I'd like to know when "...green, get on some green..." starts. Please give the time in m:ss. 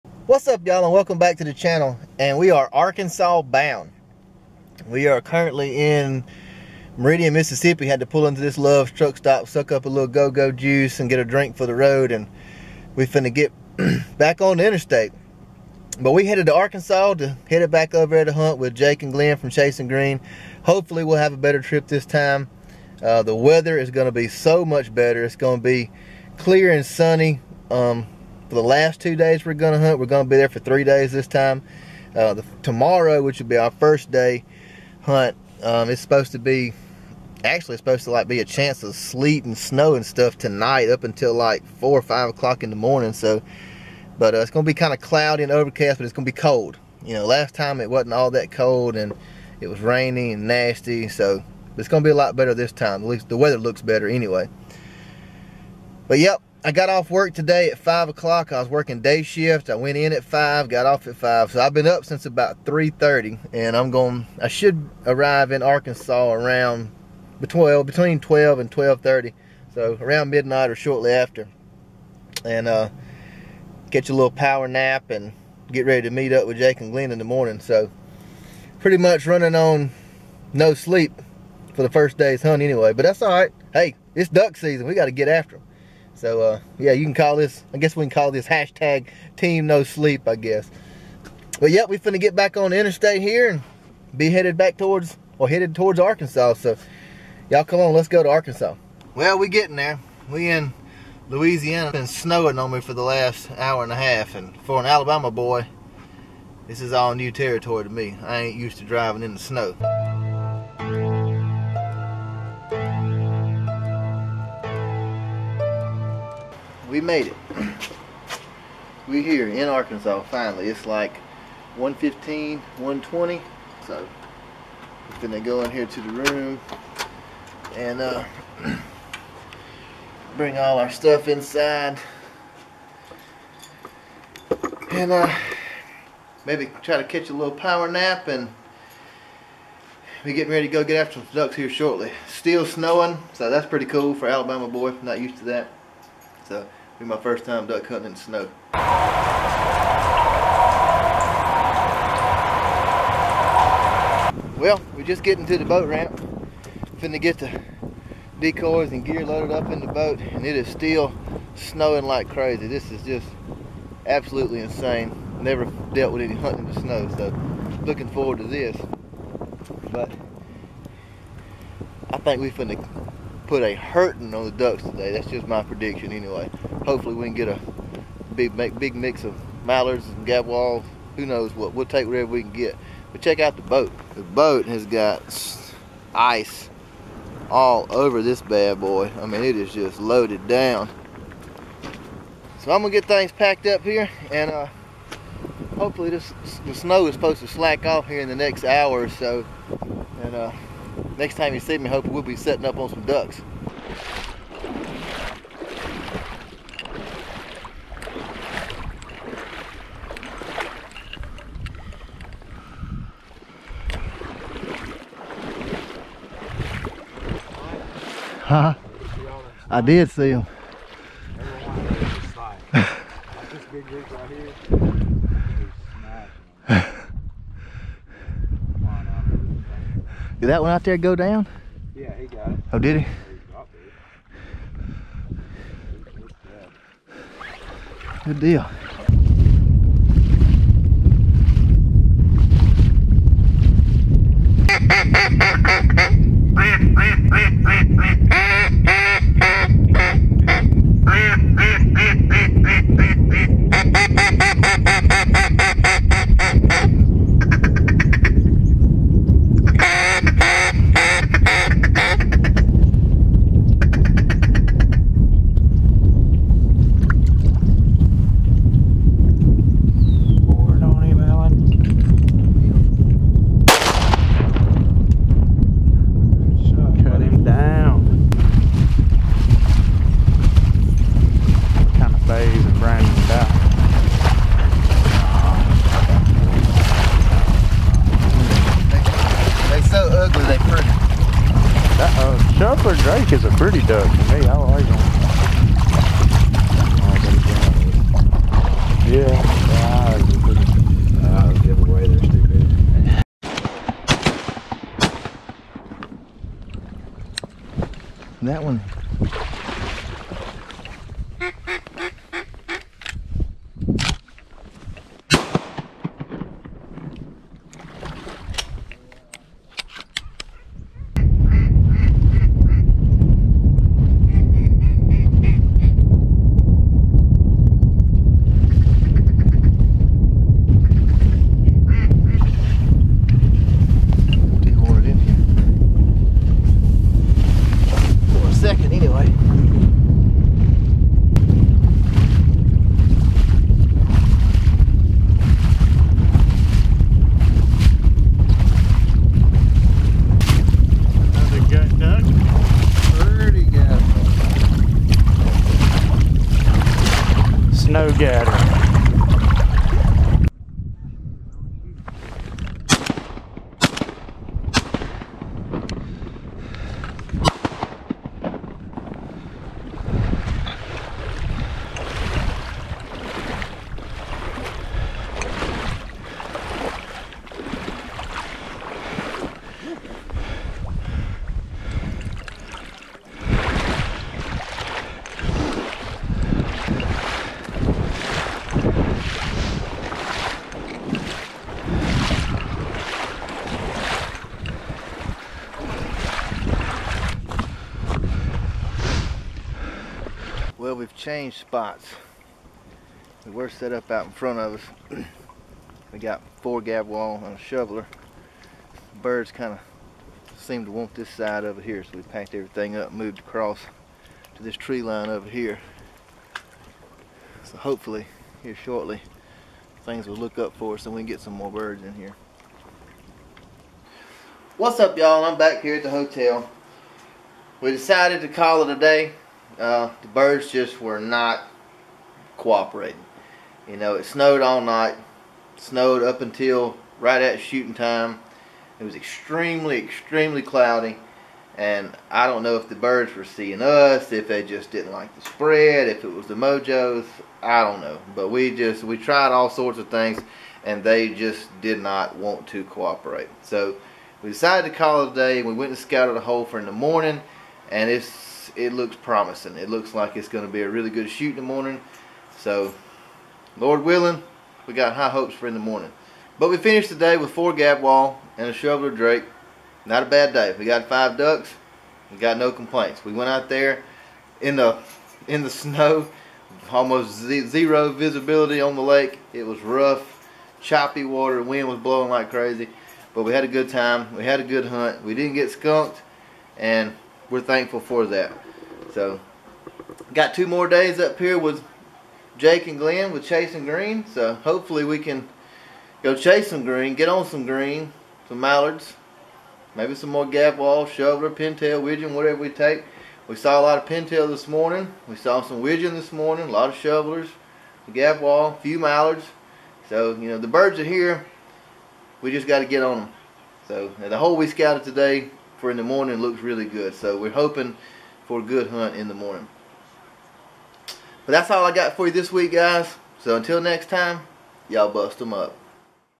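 8:16.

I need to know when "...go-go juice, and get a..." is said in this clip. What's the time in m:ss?
0:10.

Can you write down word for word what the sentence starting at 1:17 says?
So pretty much running on no sleep for the first day's hunt anyway.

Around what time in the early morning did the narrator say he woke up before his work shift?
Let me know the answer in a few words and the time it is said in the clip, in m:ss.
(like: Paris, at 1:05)
3:30, at 1:02.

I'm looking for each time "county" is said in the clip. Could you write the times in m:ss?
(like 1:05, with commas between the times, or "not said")
not said.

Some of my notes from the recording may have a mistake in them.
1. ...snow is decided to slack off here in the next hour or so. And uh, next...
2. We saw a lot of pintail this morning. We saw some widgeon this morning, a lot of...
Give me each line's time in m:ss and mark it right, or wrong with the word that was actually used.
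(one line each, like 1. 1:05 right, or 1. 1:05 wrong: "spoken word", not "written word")
1. 3:16 wrong: "supposed", not "decided"
2. 8:23 right.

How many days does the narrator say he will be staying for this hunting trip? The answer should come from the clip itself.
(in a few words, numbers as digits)
3.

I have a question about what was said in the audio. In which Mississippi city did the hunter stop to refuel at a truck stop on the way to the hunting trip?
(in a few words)
Meridian.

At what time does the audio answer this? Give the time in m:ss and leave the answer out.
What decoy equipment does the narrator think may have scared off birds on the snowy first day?
7:26.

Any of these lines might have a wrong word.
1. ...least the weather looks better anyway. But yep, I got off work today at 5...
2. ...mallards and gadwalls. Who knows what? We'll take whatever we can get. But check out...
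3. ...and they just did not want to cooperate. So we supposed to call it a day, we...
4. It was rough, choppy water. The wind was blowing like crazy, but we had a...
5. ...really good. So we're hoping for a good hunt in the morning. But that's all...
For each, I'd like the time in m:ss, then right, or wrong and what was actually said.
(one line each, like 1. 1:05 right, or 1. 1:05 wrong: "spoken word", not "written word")
1. 0:53 right
2. 2:59 right
3. 7:30 wrong: "decided", not "supposed"
4. 7:59 right
5. 8:36 right.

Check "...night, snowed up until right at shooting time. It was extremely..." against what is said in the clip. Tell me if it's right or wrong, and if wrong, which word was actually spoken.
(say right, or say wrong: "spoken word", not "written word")
right.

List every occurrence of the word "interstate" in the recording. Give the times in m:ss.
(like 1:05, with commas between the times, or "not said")
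0:14, 1:32.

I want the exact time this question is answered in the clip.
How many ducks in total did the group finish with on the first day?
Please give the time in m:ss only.
7:51.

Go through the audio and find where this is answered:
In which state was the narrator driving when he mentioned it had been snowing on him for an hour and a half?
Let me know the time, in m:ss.
1:41.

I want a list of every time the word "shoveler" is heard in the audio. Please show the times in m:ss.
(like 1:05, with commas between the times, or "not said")
6:47, 7:48, 8:21, 8:26.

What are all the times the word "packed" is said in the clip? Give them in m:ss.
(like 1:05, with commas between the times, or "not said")
3:13, 6:52.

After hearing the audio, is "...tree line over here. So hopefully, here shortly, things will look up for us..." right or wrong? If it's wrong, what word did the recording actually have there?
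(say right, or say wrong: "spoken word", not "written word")
right.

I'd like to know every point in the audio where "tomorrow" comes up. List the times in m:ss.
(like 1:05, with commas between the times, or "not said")
0:32.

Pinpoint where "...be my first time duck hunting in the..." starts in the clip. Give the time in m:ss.
2:27.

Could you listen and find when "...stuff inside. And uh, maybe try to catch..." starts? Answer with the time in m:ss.
2:10.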